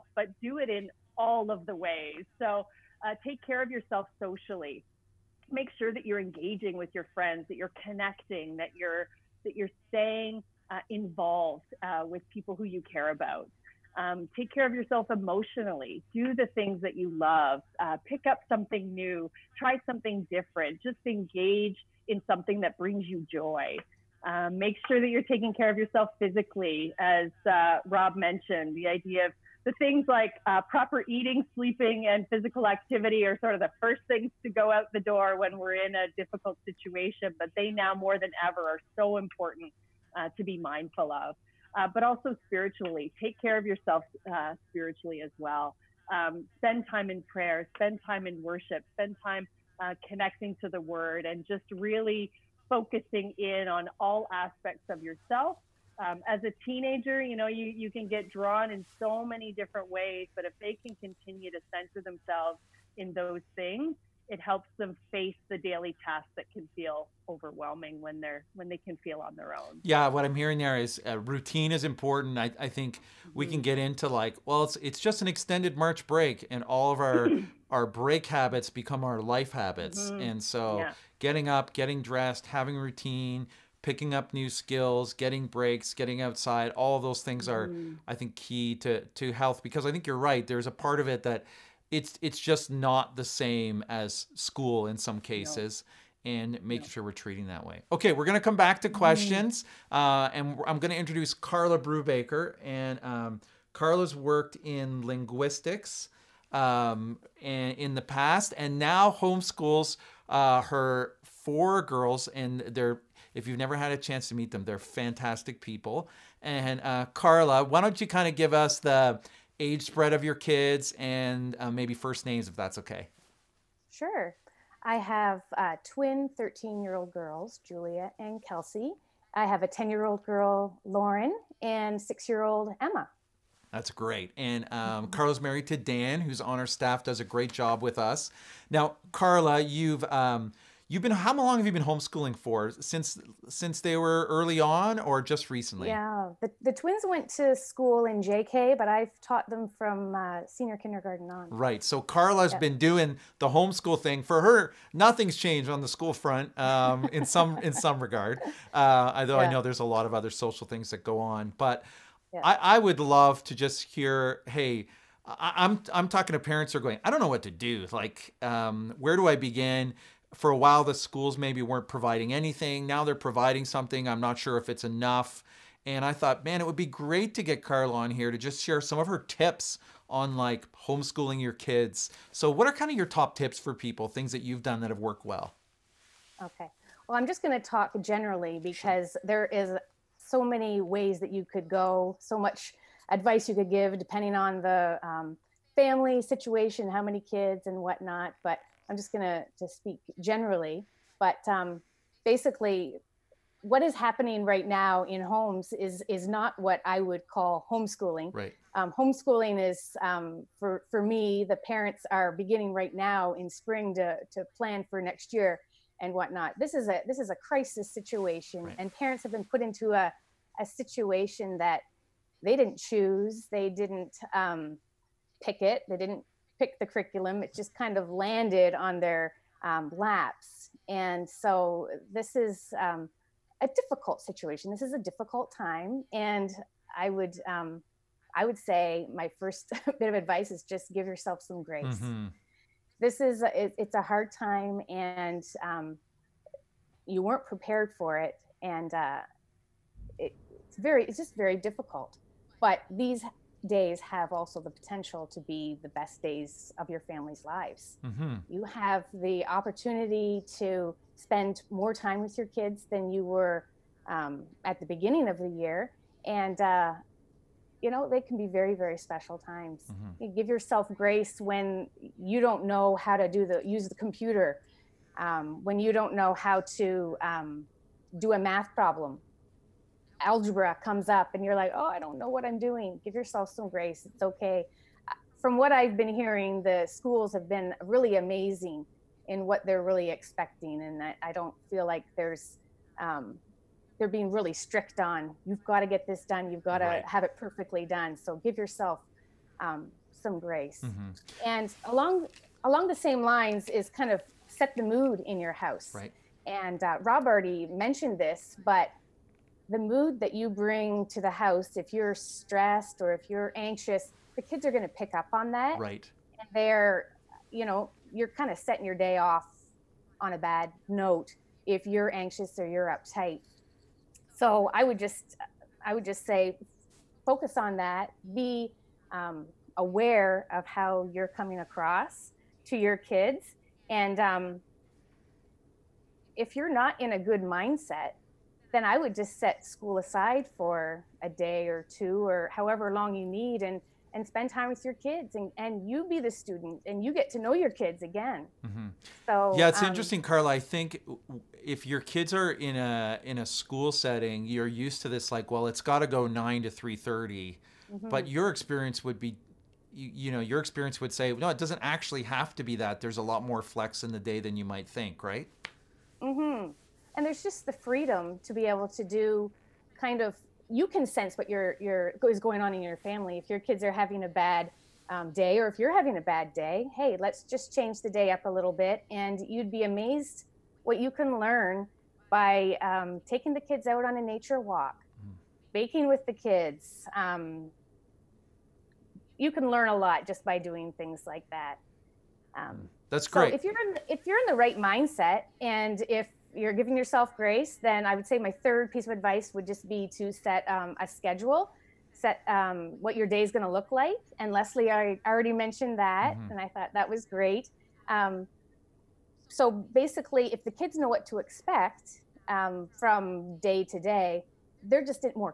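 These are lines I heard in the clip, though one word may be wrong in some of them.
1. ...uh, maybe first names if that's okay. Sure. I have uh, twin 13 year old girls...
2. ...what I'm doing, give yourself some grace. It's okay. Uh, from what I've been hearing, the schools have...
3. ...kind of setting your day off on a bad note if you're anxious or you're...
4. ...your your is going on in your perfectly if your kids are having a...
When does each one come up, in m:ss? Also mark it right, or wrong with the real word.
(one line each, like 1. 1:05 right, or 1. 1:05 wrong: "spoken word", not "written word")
1. 2:01 right
2. 4:42 right
3. 5:18 right
4. 6:11 wrong: "family", not "perfectly".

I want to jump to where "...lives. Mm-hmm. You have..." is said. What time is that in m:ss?
4:17.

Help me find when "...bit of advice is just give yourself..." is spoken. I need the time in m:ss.
3:59.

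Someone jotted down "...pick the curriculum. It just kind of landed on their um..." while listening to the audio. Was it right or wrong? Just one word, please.
right.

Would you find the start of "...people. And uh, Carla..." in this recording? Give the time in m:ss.
1:55.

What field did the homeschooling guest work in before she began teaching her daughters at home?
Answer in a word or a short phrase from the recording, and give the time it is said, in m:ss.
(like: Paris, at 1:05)
Linguistics, at 1:45.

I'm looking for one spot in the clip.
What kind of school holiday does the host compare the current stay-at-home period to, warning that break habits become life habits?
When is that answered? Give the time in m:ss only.
1:15.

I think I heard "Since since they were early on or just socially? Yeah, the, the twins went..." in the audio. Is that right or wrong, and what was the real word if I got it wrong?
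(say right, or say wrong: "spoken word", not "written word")
wrong: "recently", not "socially".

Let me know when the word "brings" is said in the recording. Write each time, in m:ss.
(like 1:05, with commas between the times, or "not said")
0:22, 5:10.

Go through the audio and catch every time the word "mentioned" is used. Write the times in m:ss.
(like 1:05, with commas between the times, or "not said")
0:28, 5:07, 6:45.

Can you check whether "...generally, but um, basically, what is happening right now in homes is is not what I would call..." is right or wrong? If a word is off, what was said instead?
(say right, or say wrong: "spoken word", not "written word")
right.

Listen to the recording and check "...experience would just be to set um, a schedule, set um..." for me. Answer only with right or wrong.
wrong.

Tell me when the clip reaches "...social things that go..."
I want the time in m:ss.
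2:40.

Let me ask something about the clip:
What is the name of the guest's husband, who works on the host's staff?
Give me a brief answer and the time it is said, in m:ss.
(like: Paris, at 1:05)
Dan, at 2:15.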